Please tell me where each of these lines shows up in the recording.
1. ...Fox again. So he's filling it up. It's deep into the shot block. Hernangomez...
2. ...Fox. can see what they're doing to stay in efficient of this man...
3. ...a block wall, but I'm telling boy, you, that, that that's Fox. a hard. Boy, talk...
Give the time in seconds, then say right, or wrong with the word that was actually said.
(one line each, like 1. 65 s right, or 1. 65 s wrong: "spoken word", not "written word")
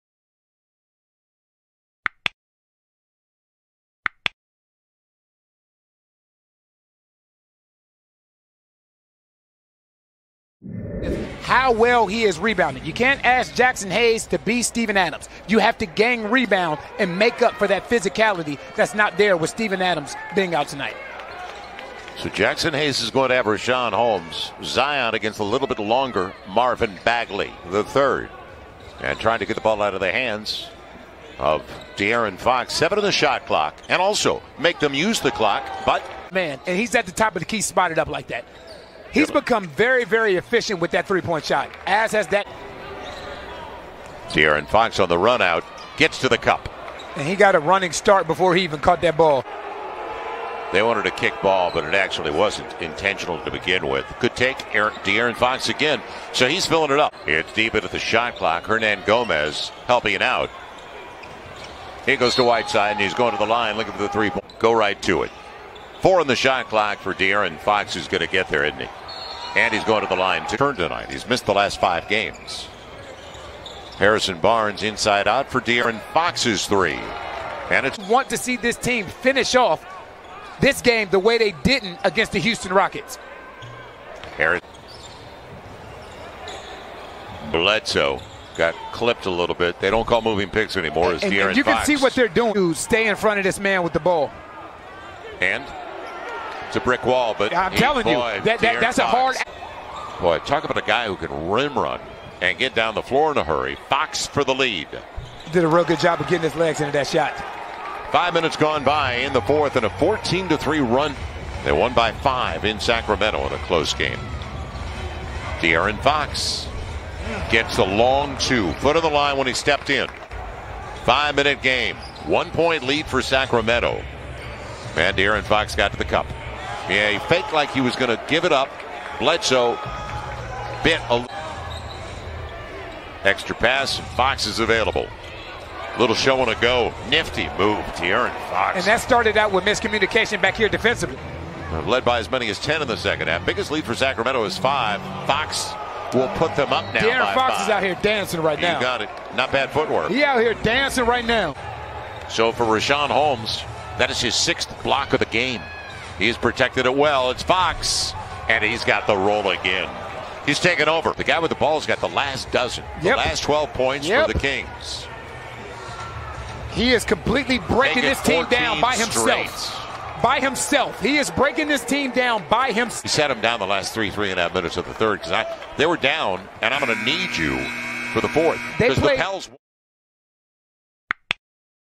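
1. 55 s wrong: "clock", not "block"
2. 91 s wrong: "front", not "efficient"
3. 96 s wrong: "brick", not "block".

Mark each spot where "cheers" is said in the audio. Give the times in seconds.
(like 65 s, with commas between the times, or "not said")
not said.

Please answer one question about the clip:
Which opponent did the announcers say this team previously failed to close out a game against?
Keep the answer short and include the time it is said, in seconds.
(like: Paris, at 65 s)
Houston Rockets, at 82 s.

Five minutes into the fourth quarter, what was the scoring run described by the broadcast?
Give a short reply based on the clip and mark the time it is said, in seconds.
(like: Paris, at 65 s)
14 to 3, at 109 s.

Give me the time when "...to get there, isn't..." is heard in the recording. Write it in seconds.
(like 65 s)
68 s.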